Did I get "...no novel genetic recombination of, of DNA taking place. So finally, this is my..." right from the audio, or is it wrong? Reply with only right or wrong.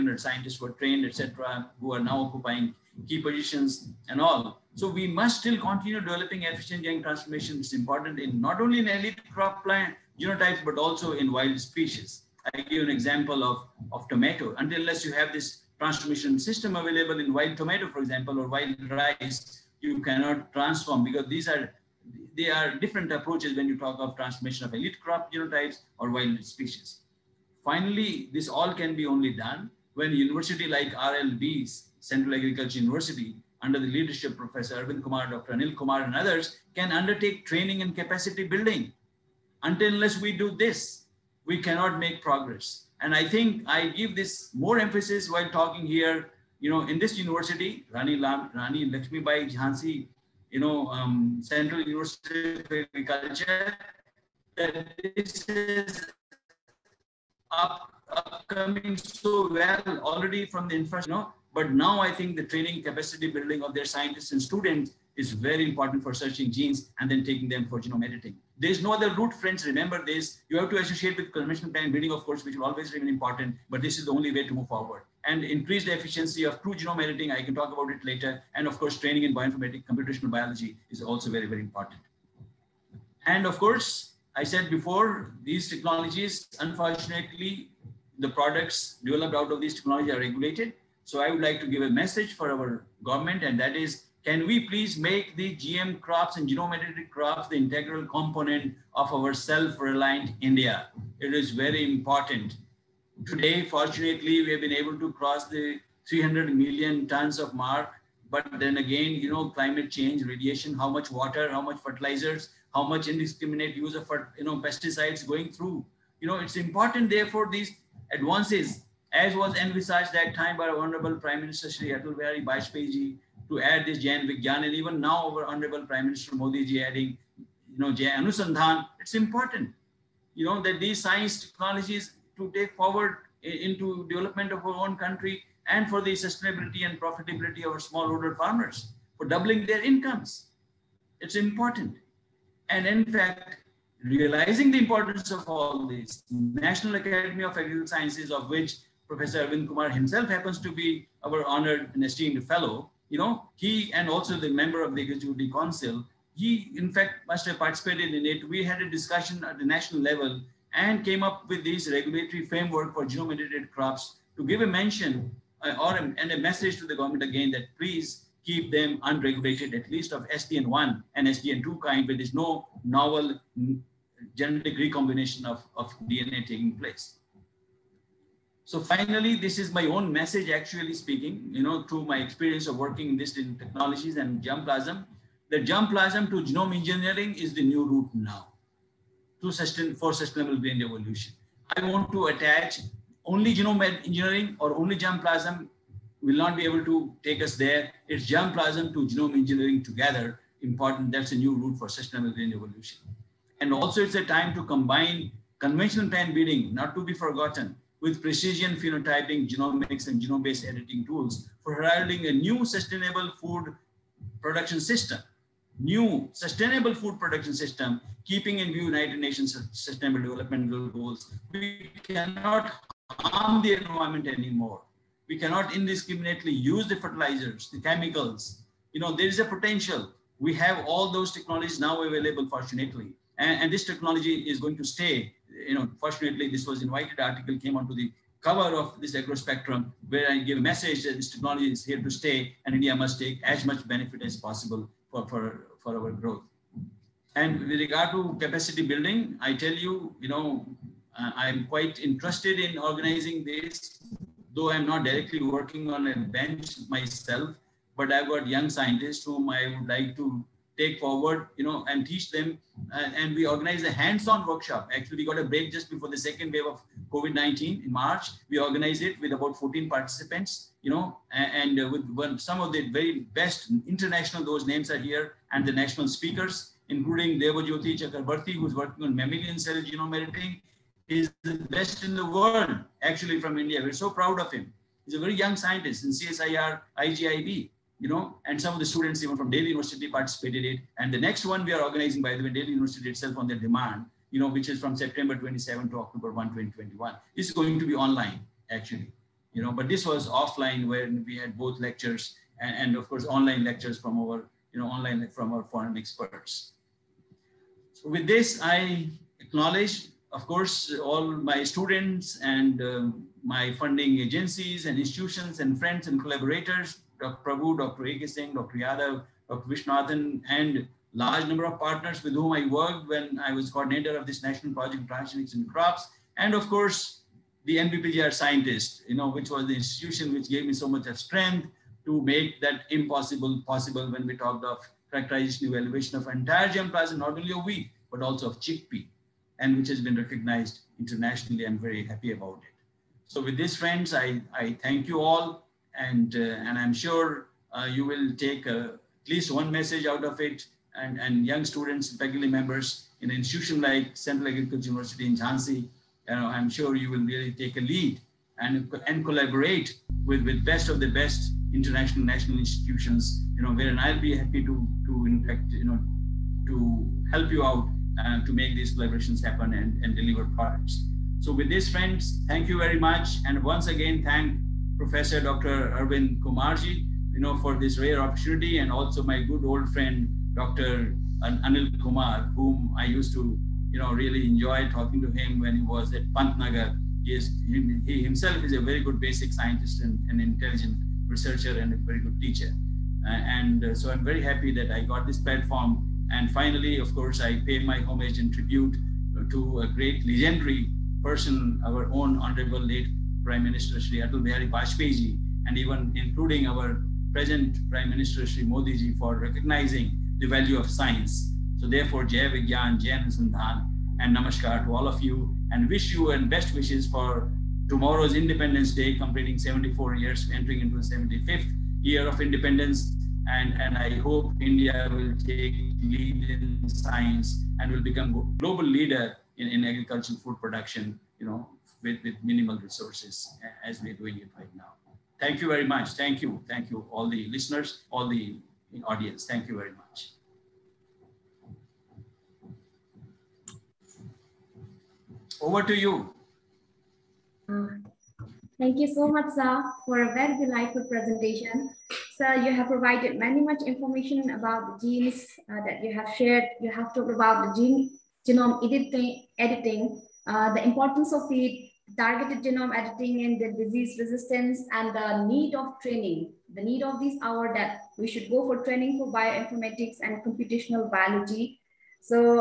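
right.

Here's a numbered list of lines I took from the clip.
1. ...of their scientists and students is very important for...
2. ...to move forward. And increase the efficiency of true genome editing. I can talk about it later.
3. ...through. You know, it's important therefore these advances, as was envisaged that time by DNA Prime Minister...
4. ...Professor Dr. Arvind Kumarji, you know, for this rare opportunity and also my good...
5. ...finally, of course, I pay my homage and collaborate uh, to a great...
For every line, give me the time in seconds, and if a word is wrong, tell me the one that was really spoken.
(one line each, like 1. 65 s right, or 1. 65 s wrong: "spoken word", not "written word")
1. 63 s right
2. 74 s right
3. 115 s wrong: "Honorable", not "DNA"
4. 374 s right
5. 396 s wrong: "tribute", not "collaborate".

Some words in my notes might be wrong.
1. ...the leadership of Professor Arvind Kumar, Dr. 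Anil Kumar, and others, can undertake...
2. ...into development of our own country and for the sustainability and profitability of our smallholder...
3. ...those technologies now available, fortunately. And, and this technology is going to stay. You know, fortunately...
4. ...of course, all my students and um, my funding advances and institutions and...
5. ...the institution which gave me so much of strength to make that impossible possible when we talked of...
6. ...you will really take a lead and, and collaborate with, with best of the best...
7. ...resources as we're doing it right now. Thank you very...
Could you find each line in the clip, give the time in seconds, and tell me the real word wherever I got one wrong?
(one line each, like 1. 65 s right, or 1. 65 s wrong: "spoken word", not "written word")
1. 33 s right
2. 133 s right
3. 231 s right
4. 310 s wrong: "agencies", not "advances"
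5. 329 s right
6. 356 s right
7. 432 s right.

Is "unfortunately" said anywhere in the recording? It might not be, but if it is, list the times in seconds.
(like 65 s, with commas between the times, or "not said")
86 s.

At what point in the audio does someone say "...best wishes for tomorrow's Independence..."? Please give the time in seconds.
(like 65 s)
416 s.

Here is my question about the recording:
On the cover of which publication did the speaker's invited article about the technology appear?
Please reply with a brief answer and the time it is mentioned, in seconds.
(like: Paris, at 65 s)
Agro Spectrum, at 239 s.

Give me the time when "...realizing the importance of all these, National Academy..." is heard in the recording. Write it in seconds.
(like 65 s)
144 s.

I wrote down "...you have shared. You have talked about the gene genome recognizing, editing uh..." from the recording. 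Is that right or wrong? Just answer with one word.
wrong.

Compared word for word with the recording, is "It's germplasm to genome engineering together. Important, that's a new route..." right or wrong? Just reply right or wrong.
right.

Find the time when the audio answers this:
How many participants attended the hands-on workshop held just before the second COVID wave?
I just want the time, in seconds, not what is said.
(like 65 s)
269 s.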